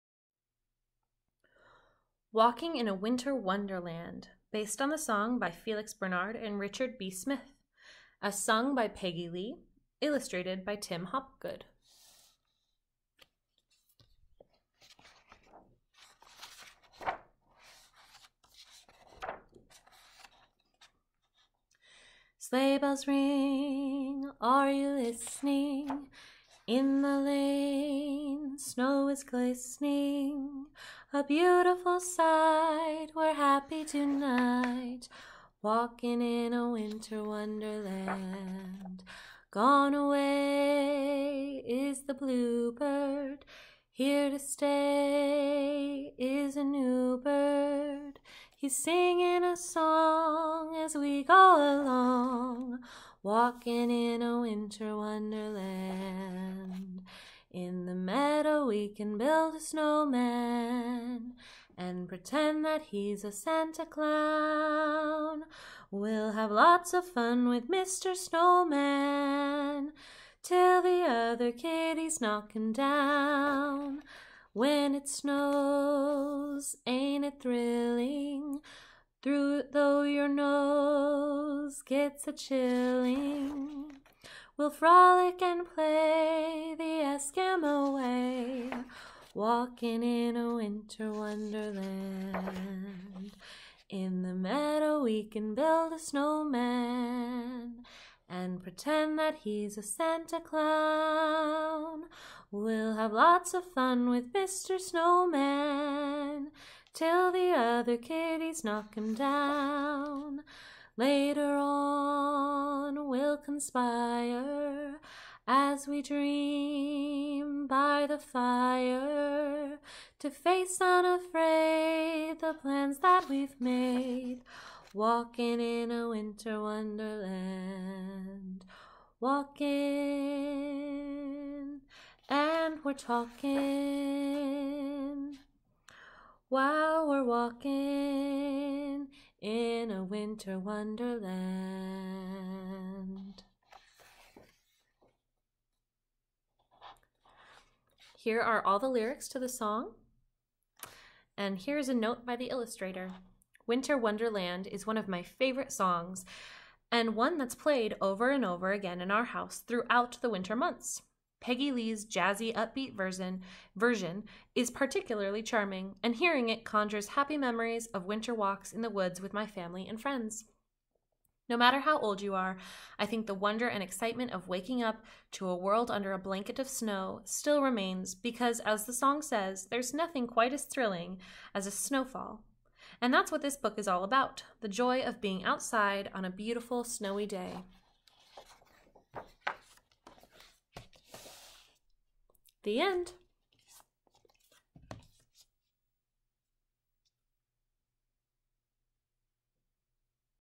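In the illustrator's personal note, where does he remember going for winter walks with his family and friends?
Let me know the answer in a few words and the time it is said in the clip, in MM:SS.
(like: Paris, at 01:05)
the woods, at 02:48.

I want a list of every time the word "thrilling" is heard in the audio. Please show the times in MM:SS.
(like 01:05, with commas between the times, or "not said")
01:17, 03:00.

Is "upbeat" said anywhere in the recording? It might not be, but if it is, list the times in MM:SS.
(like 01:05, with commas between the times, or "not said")
02:42.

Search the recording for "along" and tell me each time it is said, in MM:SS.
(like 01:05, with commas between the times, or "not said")
00:51.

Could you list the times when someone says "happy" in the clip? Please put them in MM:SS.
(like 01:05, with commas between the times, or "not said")
00:33, 02:47.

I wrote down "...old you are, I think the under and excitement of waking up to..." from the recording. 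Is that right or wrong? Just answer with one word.
wrong.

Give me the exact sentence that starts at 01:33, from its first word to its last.
In the meadow, we can build a snowman and pretend that he's a Santa Clown.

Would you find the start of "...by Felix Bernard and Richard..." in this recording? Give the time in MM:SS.
00:05.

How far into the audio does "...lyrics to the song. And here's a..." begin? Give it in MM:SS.
02:28.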